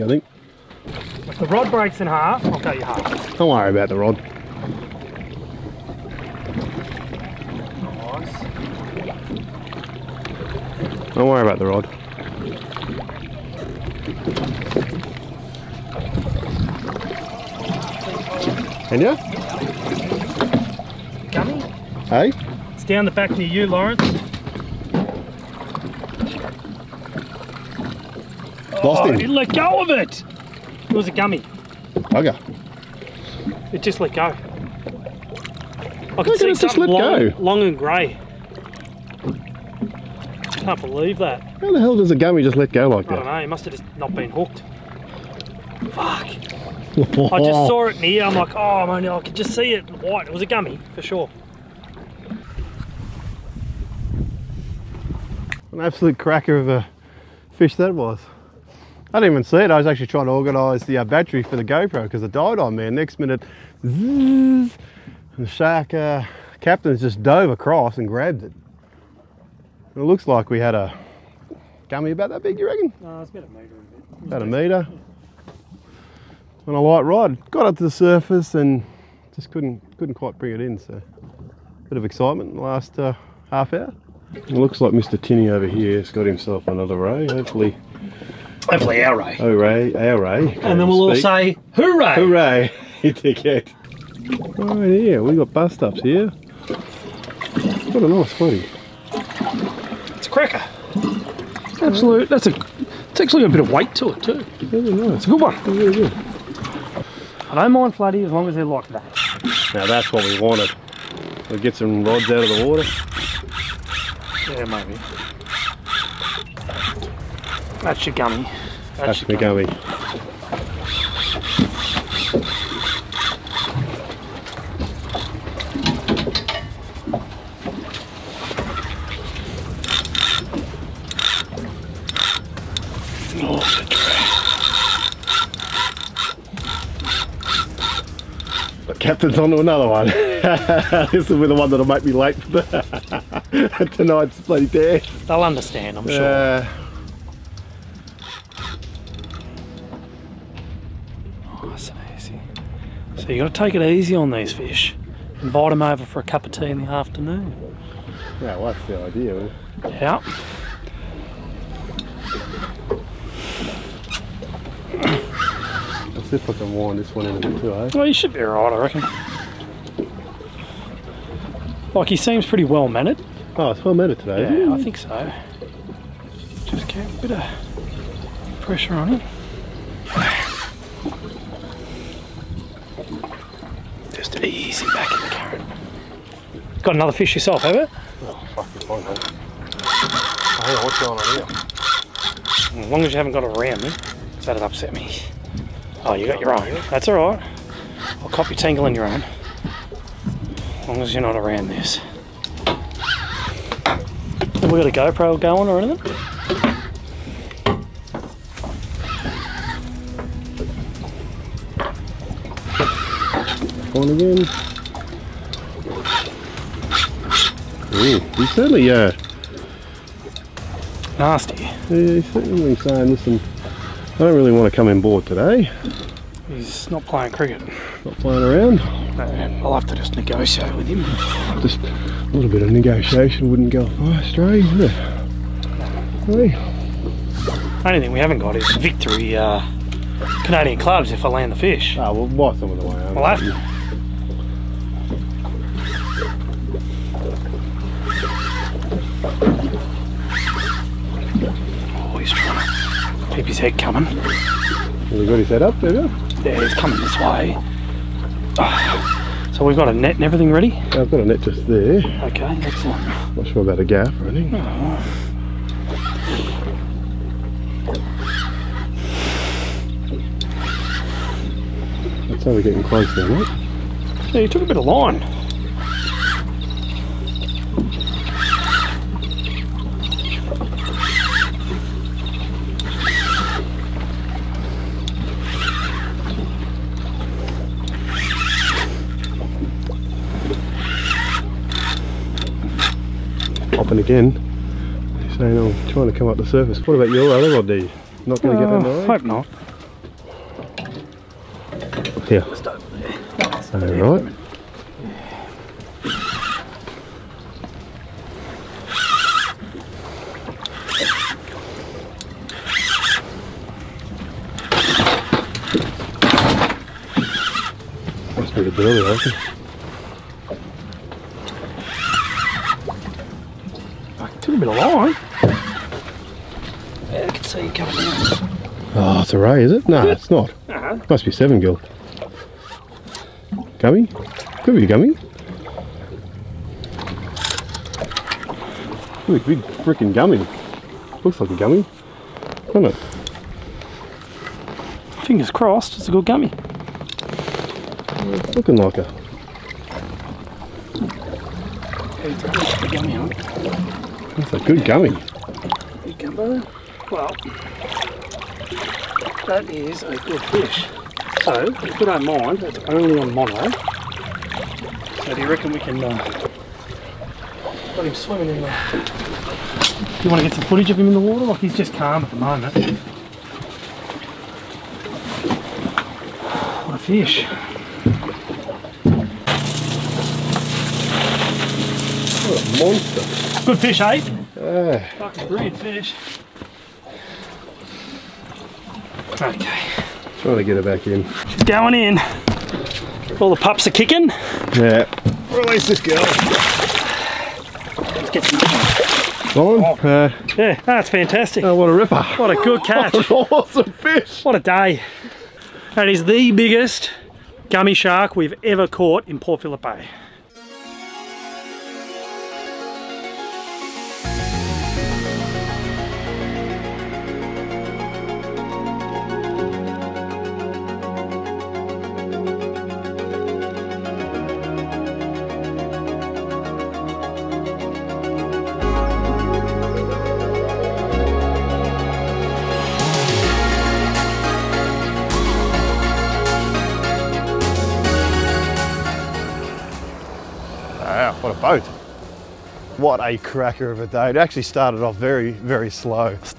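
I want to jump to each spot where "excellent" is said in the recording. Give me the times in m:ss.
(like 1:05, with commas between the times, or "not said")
4:22.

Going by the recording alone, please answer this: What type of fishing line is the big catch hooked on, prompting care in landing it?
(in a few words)
mono.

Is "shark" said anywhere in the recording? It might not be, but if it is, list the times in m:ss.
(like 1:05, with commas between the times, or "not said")
1:05, 6:47.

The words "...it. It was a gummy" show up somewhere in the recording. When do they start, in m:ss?
0:29.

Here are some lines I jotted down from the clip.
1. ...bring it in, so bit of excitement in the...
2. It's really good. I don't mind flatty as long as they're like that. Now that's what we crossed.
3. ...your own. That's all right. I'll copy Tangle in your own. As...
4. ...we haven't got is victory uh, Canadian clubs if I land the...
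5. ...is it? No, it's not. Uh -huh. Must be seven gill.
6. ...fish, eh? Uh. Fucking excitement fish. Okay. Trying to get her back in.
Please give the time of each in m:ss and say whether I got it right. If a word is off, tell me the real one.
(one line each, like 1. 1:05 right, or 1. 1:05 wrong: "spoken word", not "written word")
1. 1:20 right
2. 1:45 wrong: "wanted", not "crossed"
3. 3:16 right
4. 3:58 right
5. 5:29 right
6. 6:23 wrong: "brilliant", not "excitement".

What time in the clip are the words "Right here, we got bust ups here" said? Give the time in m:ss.
1:34.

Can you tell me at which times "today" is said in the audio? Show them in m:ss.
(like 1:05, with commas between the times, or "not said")
2:54, 3:45.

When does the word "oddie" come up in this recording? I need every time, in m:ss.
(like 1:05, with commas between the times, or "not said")
4:57.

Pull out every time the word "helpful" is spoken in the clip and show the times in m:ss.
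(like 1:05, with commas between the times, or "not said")
not said.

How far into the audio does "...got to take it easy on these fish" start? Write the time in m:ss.
2:33.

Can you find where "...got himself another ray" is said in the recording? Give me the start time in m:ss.
1:26.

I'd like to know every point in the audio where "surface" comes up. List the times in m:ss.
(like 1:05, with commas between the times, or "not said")
1:17, 4:56.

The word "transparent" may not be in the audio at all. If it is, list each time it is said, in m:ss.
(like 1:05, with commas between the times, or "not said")
not said.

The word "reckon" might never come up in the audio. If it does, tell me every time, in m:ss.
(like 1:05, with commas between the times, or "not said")
1:12, 2:48, 6:05.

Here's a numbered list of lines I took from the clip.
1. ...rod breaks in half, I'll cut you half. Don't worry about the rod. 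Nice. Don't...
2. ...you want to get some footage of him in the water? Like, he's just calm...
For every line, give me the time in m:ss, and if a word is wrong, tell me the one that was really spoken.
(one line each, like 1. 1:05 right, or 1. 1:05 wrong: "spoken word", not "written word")
1. 0:01 right
2. 6:10 right.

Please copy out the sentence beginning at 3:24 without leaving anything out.
Have we got a GoPro going or anything?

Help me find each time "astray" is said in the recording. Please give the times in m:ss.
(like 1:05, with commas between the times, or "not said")
3:54.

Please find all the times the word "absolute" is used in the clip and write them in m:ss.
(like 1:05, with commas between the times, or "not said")
0:55, 1:41.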